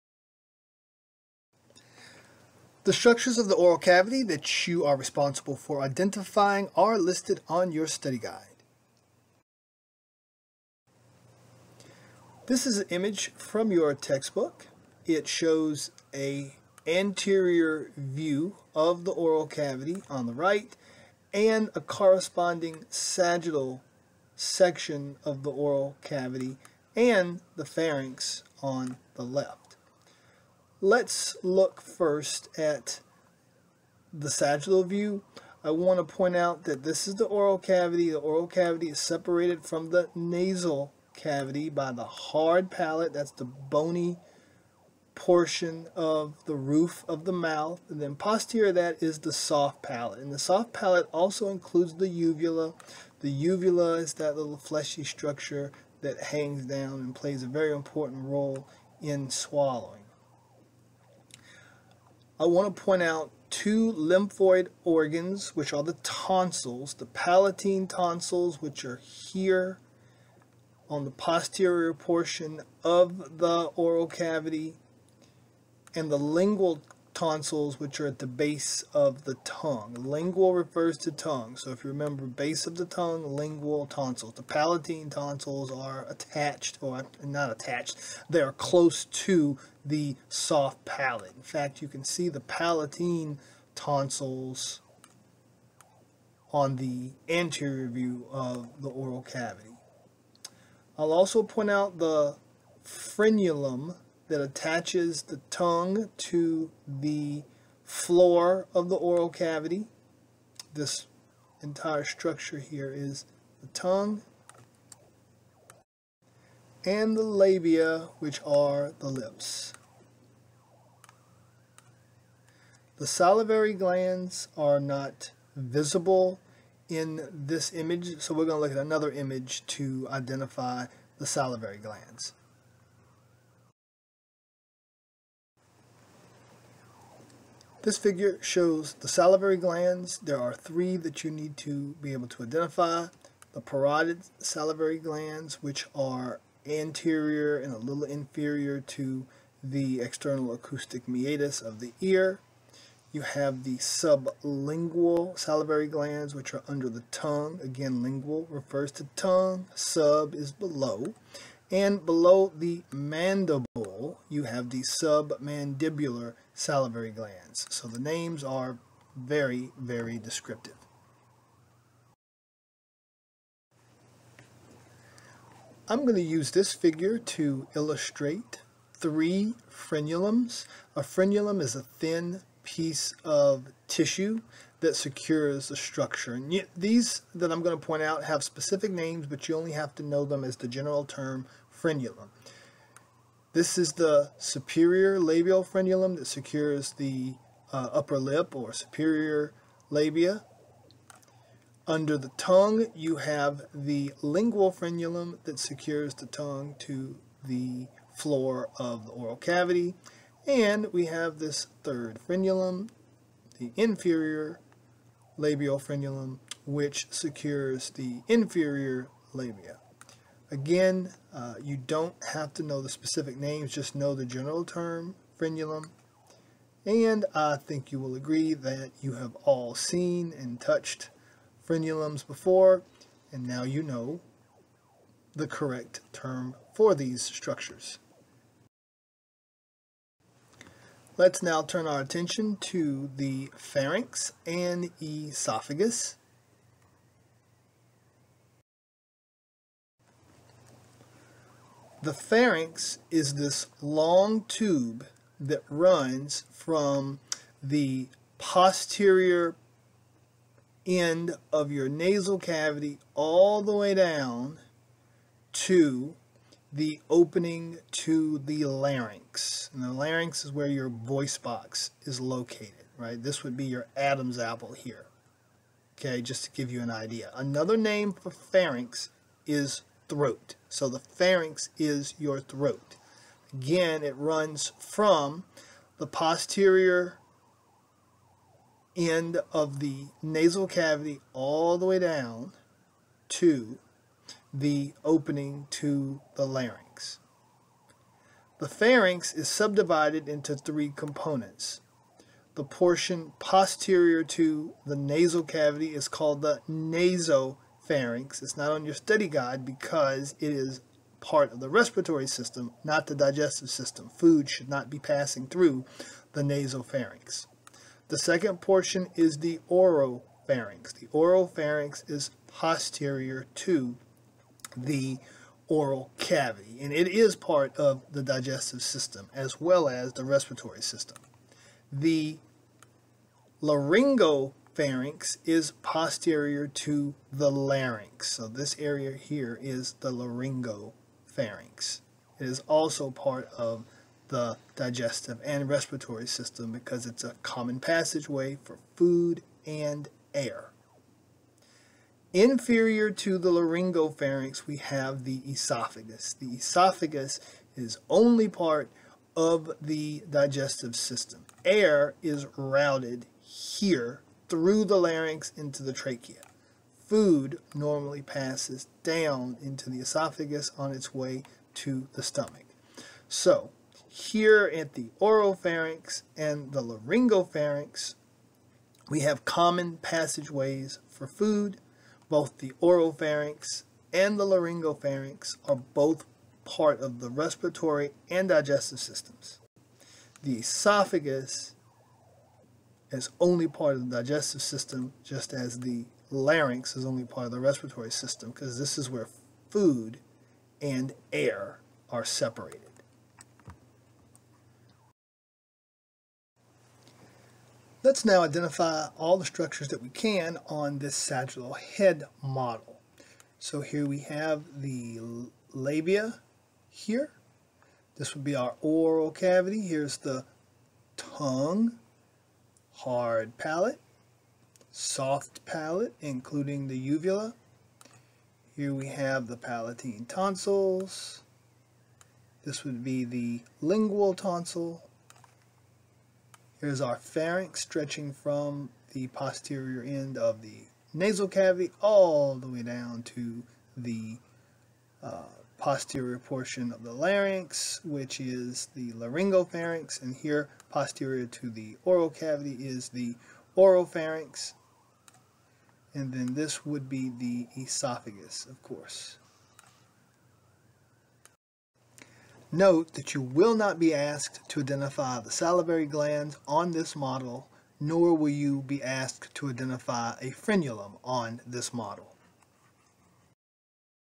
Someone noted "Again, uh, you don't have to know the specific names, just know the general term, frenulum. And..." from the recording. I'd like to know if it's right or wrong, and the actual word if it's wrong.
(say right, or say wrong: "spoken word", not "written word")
right.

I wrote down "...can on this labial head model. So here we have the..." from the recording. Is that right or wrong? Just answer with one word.
wrong.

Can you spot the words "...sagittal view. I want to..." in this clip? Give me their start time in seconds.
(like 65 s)
34 s.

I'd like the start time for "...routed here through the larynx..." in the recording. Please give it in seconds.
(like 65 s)
362 s.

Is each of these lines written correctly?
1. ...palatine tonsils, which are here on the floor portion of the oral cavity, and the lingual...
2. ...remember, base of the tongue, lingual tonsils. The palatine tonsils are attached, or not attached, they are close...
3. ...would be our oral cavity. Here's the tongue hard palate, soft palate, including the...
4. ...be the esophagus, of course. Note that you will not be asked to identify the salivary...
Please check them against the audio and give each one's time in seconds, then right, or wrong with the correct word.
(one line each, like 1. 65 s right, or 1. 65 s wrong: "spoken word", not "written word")
1. 67 s wrong: "posterior", not "floor"
2. 81 s right
3. 418 s right
4. 457 s right.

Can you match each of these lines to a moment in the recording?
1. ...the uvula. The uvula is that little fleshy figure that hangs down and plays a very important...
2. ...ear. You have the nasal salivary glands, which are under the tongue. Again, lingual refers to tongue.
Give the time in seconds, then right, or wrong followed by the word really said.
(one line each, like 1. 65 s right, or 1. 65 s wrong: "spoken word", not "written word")
1. 51 s wrong: "structure", not "figure"
2. 151 s wrong: "sublingual", not "nasal".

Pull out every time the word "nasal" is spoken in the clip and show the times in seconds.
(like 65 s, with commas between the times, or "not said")
40 s, 261 s, 290 s, 304 s, 441 s.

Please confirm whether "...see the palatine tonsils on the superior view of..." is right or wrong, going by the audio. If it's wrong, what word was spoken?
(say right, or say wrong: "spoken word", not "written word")
wrong: "anterior", not "superior".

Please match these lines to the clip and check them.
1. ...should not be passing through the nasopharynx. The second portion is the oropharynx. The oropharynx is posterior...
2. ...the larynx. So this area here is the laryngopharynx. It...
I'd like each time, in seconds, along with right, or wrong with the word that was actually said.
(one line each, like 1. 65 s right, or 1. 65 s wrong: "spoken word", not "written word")
1. 314 s right
2. 337 s right.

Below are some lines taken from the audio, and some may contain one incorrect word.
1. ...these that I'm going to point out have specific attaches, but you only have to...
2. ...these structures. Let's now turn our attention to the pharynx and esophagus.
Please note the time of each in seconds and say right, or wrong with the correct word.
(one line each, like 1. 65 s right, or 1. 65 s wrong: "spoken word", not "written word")
1. 186 s wrong: "names", not "attaches"
2. 236 s right.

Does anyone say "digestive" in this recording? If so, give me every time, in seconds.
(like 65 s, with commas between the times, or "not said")
313 s, 328 s, 344 s, 360 s, 388 s, 394 s.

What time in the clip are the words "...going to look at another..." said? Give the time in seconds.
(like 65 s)
128 s.